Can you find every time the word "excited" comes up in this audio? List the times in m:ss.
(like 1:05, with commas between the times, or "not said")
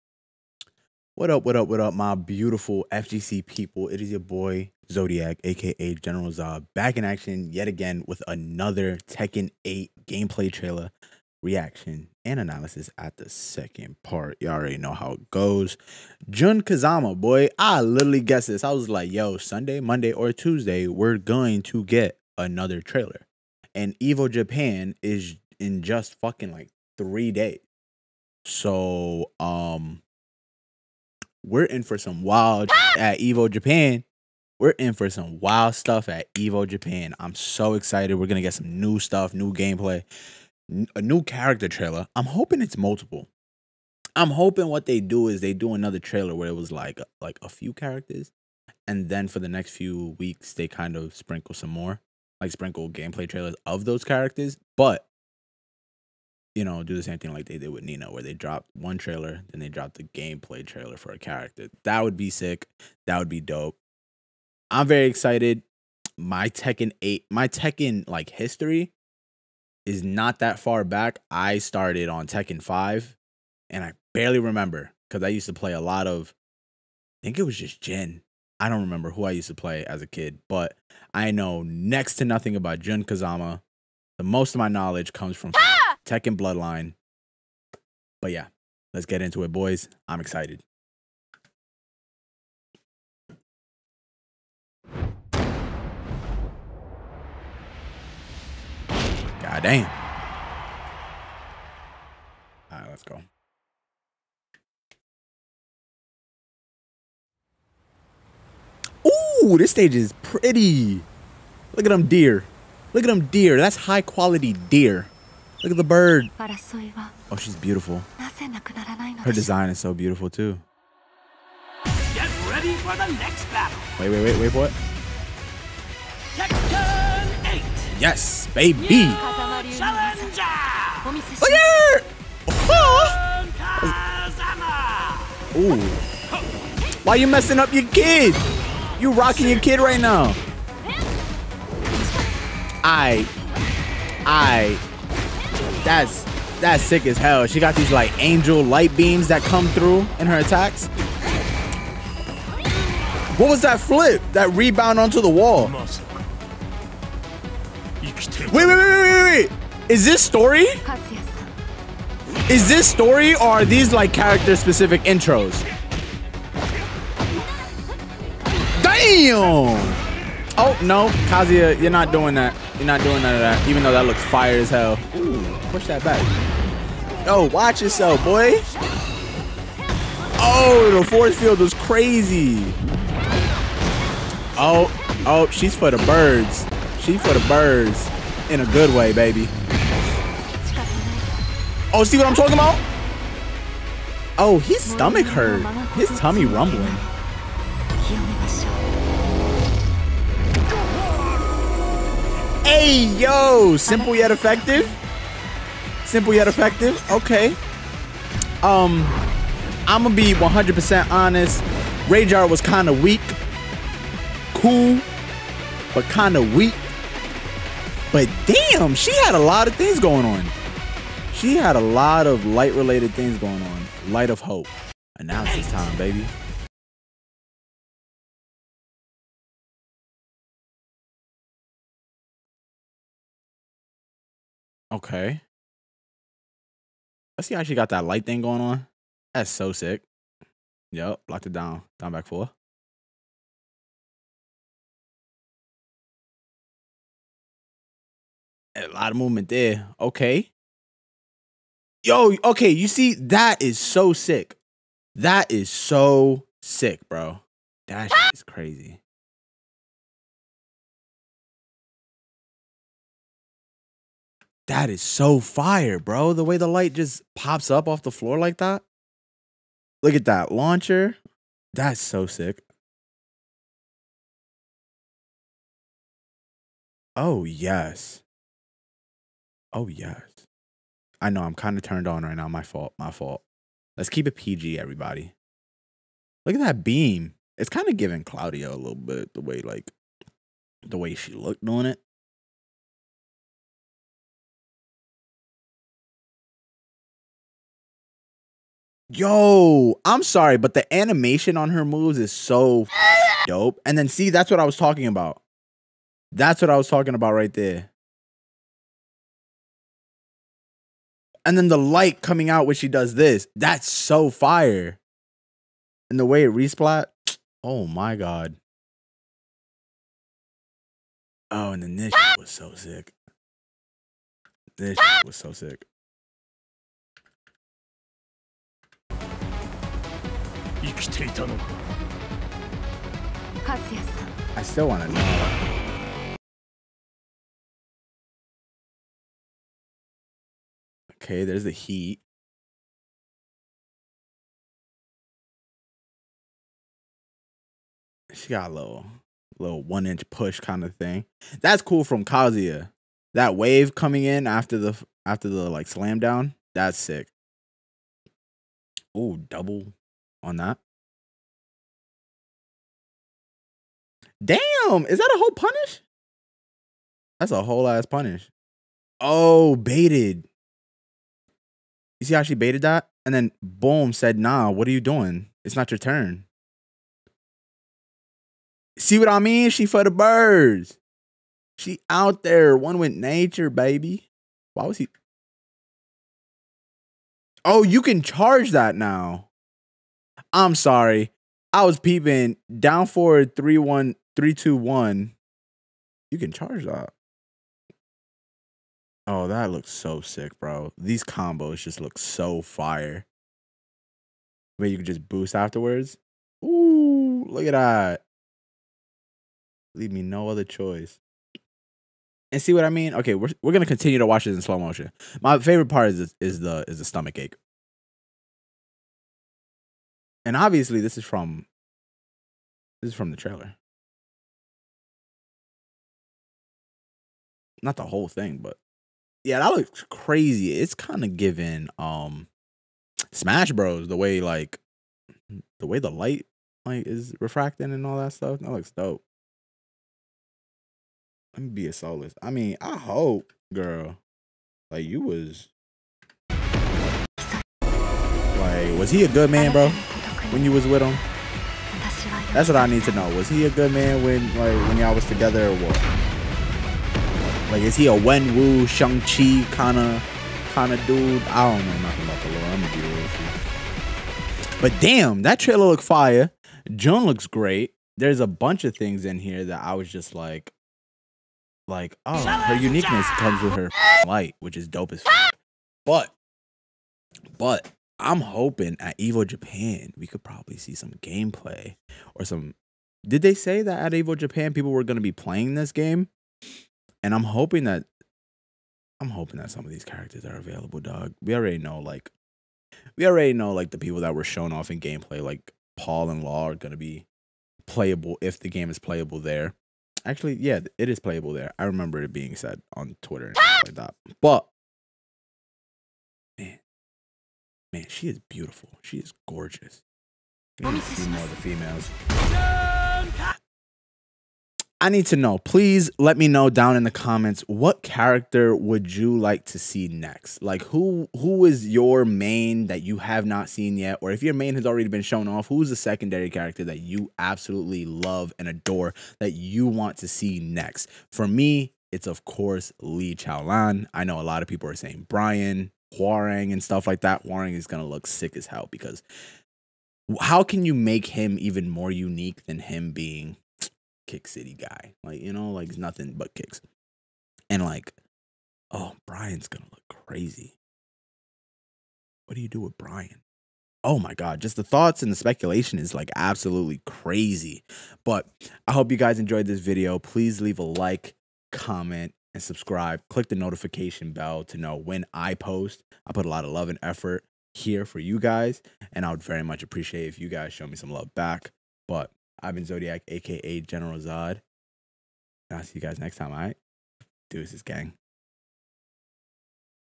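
0:37, 1:05, 1:30.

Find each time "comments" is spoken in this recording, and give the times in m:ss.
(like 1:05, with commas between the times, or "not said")
8:37, 9:21.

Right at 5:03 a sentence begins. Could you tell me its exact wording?
And then see, that's what I was talking about.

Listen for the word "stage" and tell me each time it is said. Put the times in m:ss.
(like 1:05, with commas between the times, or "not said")
1:49.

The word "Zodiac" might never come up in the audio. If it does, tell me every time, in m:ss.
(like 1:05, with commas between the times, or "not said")
0:04, 9:32.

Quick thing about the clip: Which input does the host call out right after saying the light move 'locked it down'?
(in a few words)
Down back four.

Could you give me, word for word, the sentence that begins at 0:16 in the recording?
Jun Kazama, boy, I literally guessed this.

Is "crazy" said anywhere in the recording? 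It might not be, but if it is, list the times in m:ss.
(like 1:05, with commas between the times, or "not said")
3:01, 4:18, 7:10, 9:10, 9:17.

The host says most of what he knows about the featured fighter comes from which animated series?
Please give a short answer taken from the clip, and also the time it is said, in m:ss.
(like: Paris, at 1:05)
Tekken Bloodline, at 1:26.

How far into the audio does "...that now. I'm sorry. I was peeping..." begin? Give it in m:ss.
6:28.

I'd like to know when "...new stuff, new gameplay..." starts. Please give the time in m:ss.
0:38.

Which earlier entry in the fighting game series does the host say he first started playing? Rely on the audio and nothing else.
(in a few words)
Tekken 5.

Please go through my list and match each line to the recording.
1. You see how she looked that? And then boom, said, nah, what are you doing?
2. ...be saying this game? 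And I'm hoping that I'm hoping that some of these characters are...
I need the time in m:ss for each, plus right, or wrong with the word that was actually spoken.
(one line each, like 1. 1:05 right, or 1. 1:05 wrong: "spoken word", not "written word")
1. 6:12 wrong: "baited", not "looked"
2. 8:05 wrong: "playing", not "saying".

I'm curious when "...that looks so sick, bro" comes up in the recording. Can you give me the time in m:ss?
6:39.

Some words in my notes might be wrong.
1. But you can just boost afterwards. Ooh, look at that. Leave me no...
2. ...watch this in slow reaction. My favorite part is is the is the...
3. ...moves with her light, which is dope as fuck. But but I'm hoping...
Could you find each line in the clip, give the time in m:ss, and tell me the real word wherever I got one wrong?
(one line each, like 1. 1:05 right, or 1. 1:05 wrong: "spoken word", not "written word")
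1. 6:44 right
2. 6:54 wrong: "motion", not "reaction"
3. 7:53 wrong: "comes", not "moves".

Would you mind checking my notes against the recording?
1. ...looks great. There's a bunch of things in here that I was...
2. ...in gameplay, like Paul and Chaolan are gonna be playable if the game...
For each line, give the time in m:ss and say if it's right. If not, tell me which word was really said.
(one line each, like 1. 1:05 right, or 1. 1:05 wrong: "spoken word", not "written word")
1. 7:47 right
2. 8:14 wrong: "Law", not "Chaolan".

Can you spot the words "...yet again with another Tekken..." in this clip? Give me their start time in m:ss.
0:07.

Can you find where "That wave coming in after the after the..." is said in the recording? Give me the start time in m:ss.
5:53.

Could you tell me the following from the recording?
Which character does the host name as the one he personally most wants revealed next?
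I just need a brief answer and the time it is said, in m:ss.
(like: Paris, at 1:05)
Lee Chaolan, at 8:53.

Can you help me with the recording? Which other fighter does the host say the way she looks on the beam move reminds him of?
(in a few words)
Claudio.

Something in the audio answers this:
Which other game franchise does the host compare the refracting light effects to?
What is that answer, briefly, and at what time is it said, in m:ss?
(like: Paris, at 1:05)
Smash Bros, at 7:13.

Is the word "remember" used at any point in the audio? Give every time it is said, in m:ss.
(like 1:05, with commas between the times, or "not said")
1:14, 1:18, 8:21.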